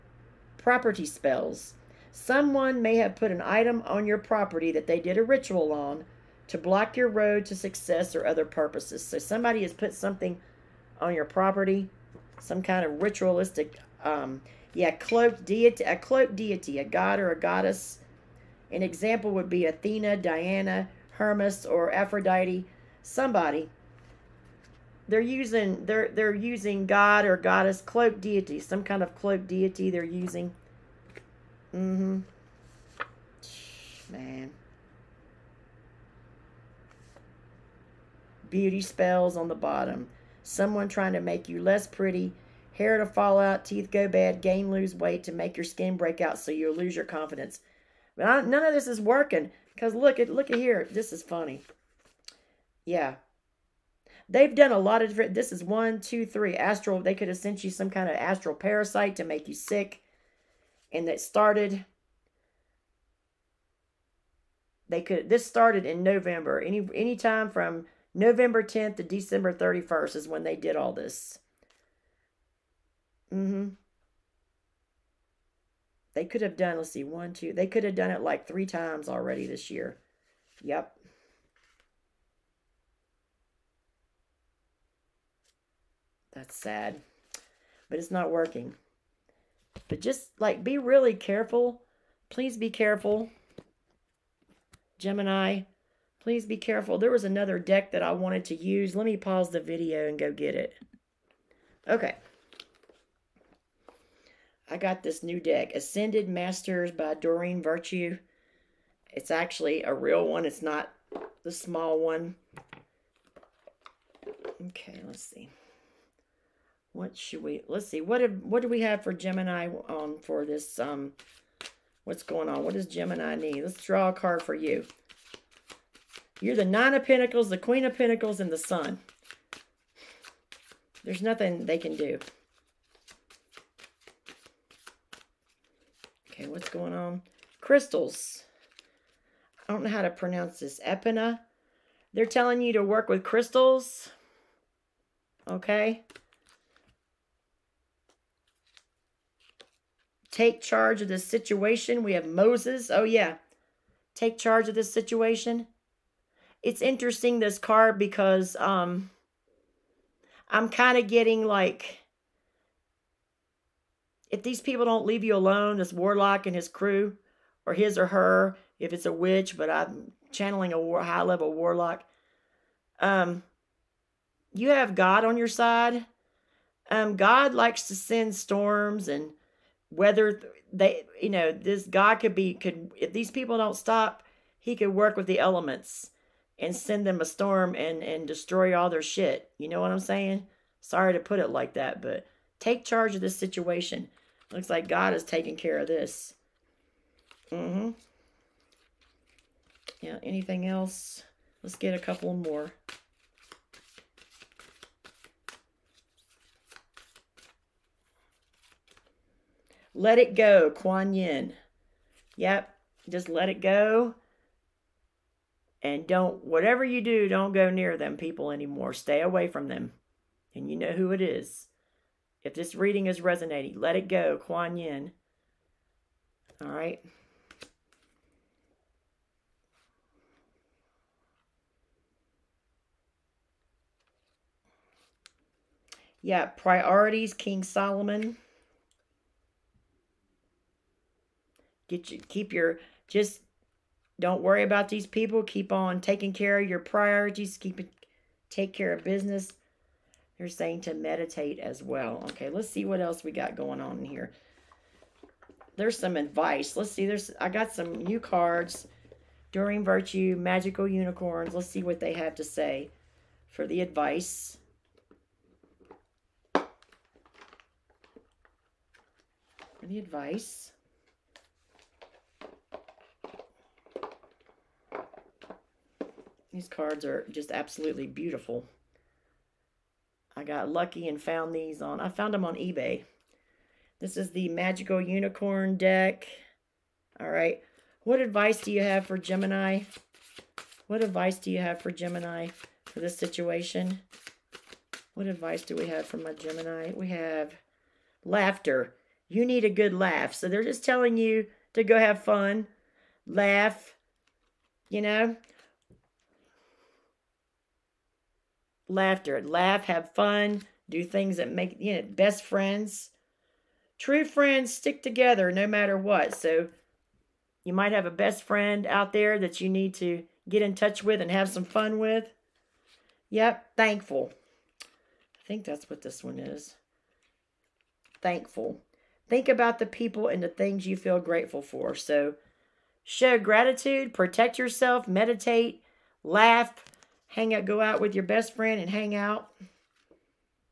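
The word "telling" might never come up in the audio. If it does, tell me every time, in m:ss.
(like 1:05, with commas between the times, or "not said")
2:22, 5:00.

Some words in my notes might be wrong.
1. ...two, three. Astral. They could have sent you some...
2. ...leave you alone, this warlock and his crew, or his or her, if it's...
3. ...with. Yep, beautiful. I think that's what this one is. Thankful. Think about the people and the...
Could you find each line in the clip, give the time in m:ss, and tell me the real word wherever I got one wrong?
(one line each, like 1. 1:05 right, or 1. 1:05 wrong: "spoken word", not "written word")
1. 0:56 right
2. 2:45 right
3. 5:21 wrong: "thankful", not "beautiful".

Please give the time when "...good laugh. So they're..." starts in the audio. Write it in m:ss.
4:59.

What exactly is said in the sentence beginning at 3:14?
Looks like God is taking care of this.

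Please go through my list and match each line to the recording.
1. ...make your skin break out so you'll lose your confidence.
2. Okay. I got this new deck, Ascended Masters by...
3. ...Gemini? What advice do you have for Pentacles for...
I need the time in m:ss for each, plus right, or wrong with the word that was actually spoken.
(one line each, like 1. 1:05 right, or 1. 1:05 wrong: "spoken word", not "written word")
1. 0:45 right
2. 1:41 right
3. 4:49 wrong: "Gemini", not "Pentacles".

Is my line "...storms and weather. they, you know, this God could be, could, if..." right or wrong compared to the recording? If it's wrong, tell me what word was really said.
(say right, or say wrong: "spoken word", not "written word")
right.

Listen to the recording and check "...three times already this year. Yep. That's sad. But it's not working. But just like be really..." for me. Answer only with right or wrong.
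right.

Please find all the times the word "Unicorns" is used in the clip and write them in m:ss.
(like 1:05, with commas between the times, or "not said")
4:20, 4:45.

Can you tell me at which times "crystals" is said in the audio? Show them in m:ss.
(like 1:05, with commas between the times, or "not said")
2:17, 2:23.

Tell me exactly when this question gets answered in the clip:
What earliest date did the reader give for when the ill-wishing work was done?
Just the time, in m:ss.
1:08.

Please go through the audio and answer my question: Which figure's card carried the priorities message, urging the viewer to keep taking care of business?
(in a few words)
King Solomon.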